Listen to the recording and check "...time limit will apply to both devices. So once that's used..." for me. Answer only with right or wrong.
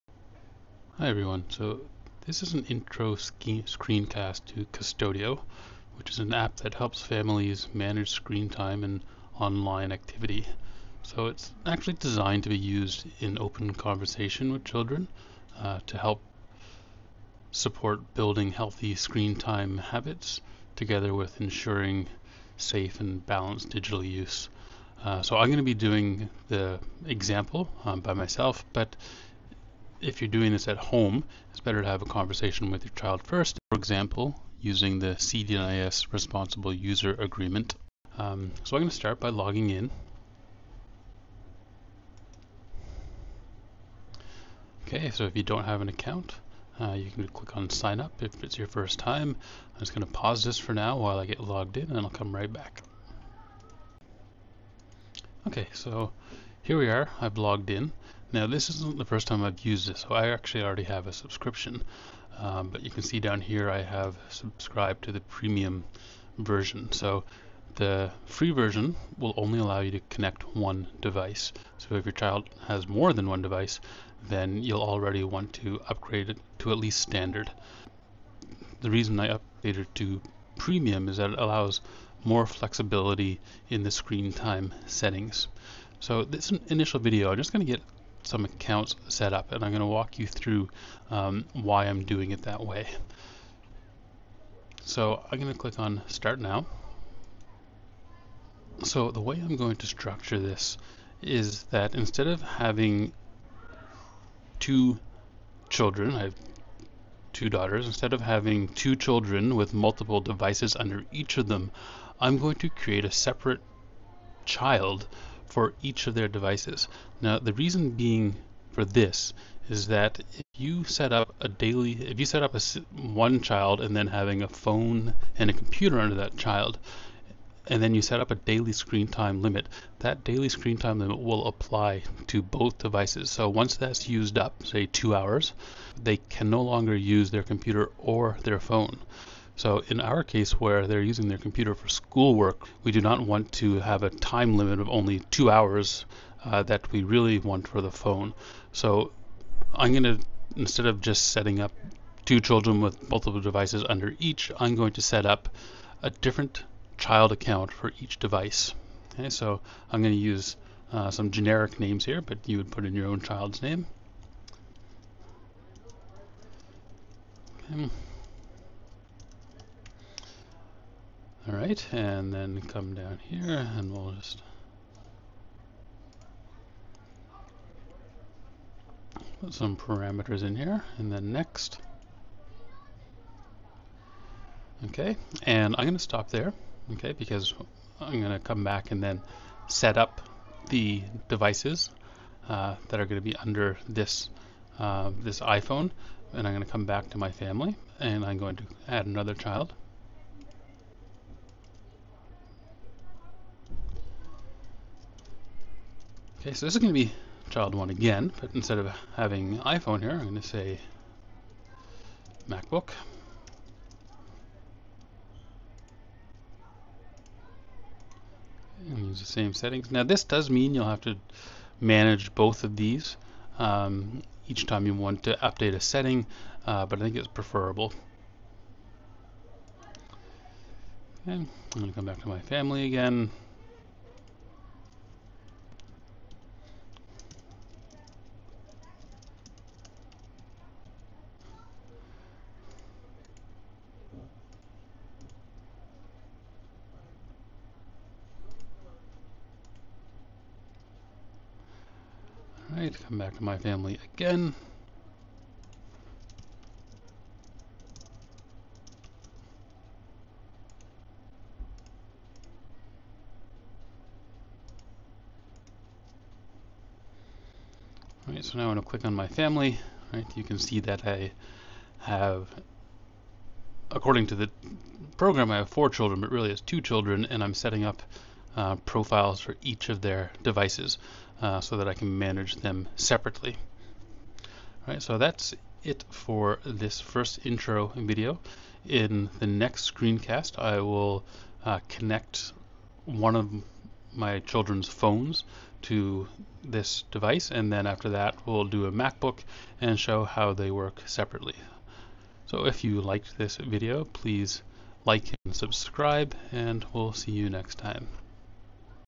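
right.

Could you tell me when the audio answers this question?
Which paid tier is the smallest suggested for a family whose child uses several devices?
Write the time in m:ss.
1:16.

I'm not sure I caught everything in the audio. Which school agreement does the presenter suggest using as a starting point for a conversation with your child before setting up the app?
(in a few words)
CDNIS Responsible User Agreement.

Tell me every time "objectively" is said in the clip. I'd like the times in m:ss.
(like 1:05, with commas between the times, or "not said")
not said.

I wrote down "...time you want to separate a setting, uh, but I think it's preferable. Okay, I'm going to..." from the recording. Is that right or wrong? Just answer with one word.
wrong.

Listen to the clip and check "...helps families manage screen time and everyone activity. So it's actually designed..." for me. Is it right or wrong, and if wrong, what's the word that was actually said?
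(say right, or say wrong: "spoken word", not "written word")
wrong: "online", not "everyone".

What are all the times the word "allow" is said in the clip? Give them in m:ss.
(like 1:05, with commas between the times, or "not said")
1:09, 1:21.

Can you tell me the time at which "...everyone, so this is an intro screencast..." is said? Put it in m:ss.
0:01.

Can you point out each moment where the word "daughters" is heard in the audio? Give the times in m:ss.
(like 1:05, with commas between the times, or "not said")
1:47.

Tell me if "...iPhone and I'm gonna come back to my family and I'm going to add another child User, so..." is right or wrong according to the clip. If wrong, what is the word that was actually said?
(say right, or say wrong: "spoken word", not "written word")
wrong: "Okay", not "User".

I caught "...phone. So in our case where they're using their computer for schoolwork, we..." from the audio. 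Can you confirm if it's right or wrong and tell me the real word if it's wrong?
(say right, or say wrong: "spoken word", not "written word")
right.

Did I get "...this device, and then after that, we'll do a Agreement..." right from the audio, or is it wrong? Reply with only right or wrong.
wrong.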